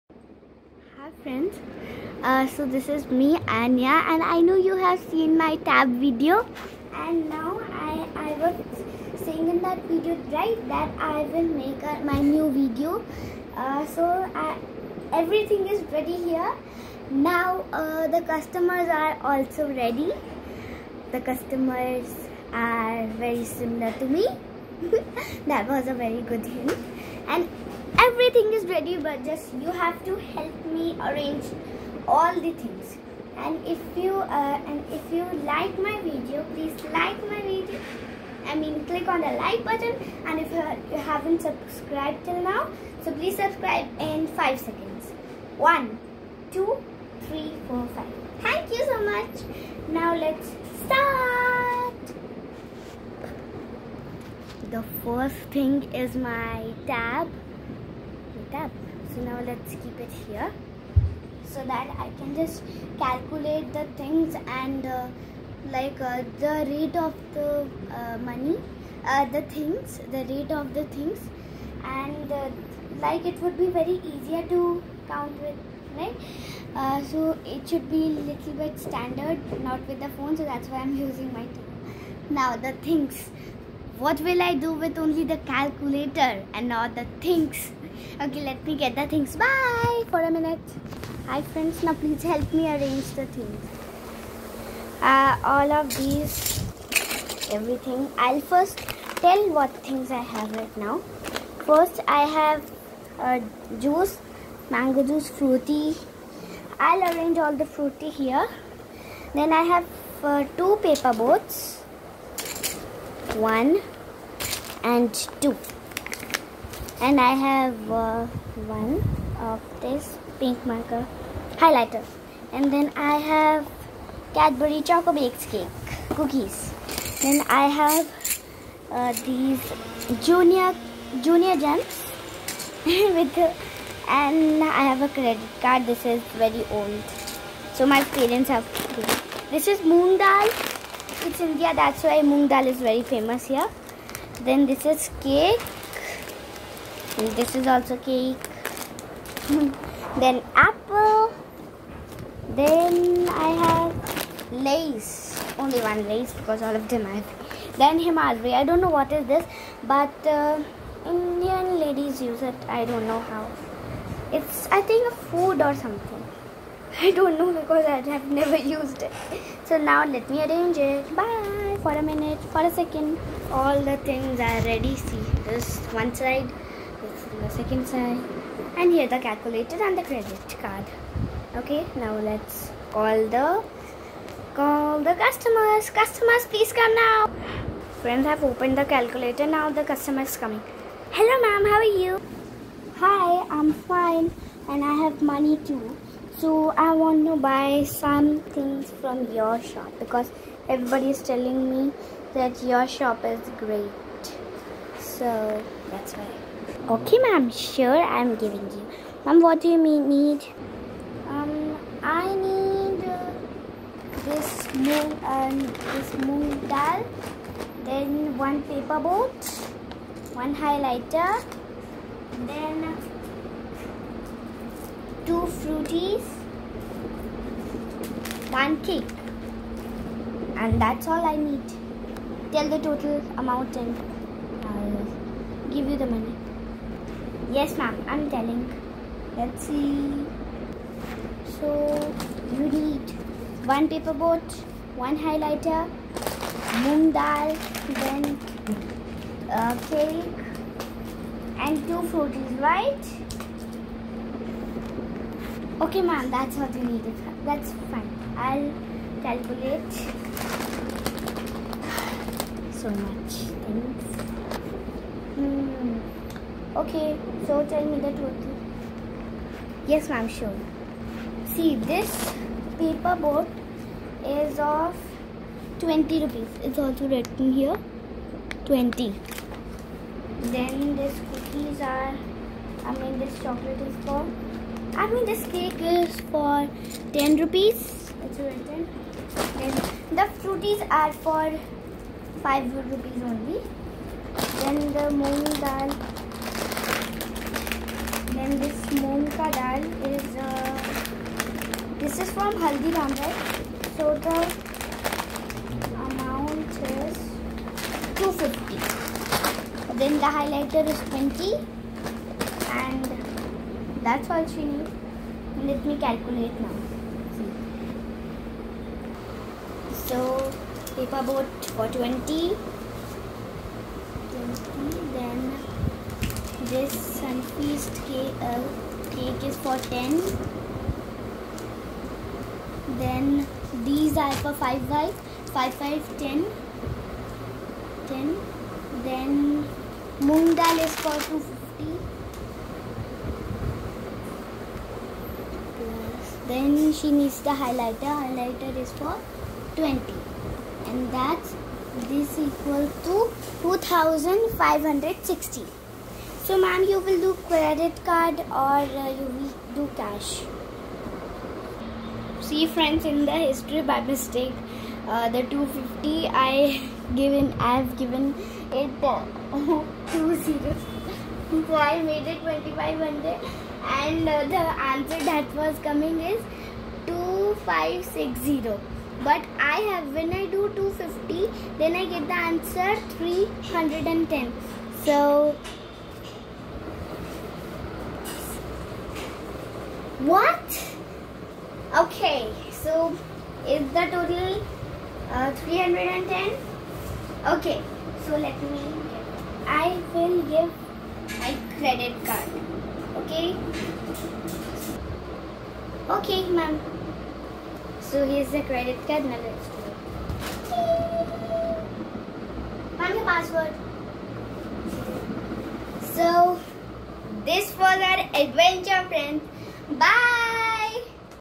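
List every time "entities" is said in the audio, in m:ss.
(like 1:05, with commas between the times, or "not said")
not said.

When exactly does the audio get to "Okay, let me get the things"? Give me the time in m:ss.
1:28.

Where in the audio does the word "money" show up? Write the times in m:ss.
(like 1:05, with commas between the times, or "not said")
1:08, 3:15, 3:56.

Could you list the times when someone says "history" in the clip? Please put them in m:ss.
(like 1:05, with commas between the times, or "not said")
6:03.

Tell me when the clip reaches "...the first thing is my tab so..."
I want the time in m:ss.
0:54.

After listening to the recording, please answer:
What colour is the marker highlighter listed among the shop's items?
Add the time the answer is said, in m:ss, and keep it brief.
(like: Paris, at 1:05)
Pink, at 2:00.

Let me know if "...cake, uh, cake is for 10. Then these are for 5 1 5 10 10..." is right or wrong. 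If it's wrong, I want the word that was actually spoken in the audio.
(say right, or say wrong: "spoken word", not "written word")
wrong: "5", not "1".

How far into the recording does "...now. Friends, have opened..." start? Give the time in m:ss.
3:06.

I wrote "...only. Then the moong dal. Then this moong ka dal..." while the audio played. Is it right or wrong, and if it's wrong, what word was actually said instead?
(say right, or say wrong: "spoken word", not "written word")
right.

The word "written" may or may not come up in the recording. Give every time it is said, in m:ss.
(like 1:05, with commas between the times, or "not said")
4:37, 4:48.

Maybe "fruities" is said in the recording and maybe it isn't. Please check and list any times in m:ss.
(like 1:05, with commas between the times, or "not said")
3:45, 4:12, 4:50.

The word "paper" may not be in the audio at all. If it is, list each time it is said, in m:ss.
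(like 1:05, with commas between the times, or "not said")
1:50, 3:38, 4:03, 4:32, 5:20.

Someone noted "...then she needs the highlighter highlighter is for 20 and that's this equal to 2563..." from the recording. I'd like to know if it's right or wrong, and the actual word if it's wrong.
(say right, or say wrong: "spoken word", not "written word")
wrong: "2560", not "2563".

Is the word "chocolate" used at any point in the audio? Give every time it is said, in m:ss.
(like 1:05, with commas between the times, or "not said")
2:04, 4:43.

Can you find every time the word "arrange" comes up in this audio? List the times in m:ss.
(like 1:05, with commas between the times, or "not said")
0:31, 1:32, 1:47, 2:50.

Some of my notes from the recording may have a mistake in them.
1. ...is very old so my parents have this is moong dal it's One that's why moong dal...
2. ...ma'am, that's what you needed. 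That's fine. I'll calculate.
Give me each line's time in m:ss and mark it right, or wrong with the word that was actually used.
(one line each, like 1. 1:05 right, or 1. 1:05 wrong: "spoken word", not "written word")
1. 2:16 wrong: "India", not "One"
2. 4:16 right.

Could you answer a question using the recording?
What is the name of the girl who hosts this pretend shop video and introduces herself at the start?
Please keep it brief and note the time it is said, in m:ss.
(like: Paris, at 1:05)
Anya, at 0:03.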